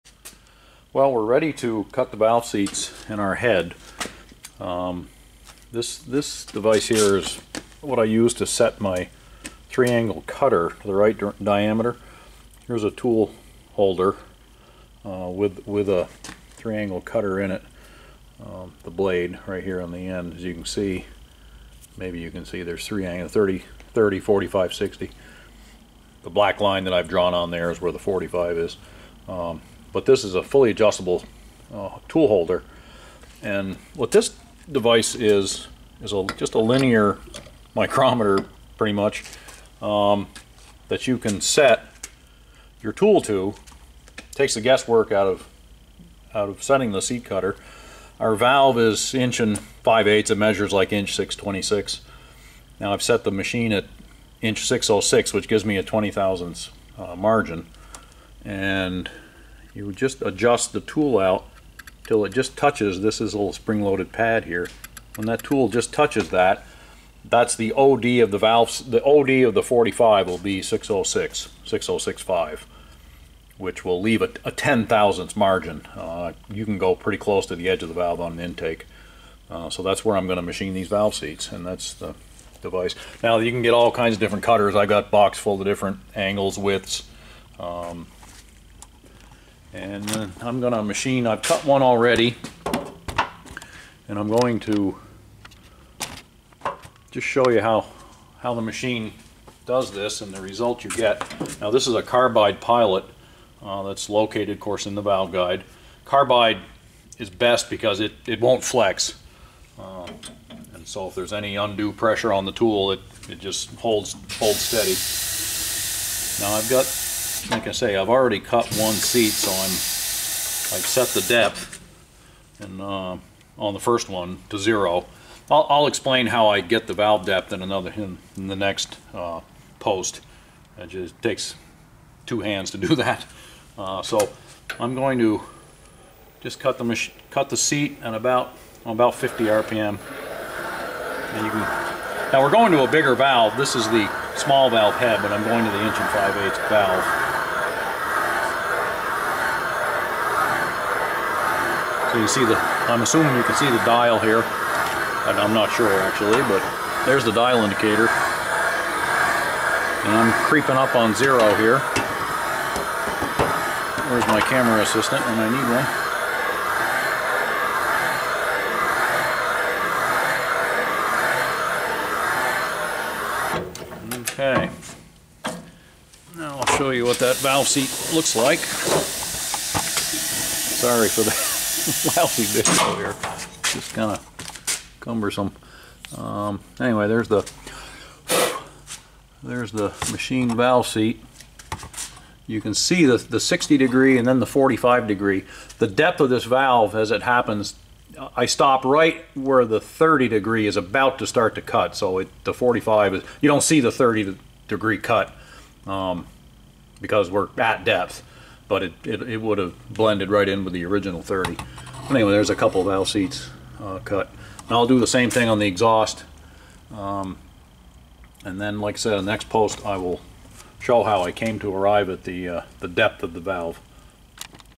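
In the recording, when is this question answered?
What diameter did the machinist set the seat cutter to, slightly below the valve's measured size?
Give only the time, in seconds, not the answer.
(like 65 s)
54 s.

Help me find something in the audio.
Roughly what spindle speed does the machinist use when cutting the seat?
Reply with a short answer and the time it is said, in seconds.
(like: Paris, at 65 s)
50 RPM, at 139 s.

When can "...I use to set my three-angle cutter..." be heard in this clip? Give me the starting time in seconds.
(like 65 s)
7 s.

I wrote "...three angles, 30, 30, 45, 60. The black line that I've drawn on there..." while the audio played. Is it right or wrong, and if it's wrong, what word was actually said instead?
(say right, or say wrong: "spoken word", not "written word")
right.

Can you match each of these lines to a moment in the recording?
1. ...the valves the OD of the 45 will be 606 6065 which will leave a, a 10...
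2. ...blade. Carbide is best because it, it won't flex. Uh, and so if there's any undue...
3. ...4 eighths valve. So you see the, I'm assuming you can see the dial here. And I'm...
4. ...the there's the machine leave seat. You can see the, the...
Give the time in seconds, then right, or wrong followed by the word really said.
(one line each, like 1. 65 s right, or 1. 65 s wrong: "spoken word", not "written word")
1. 68 s right
2. 105 s wrong: "guide", not "blade"
3. 146 s wrong: "5", not "4"
4. 187 s wrong: "valve", not "leave".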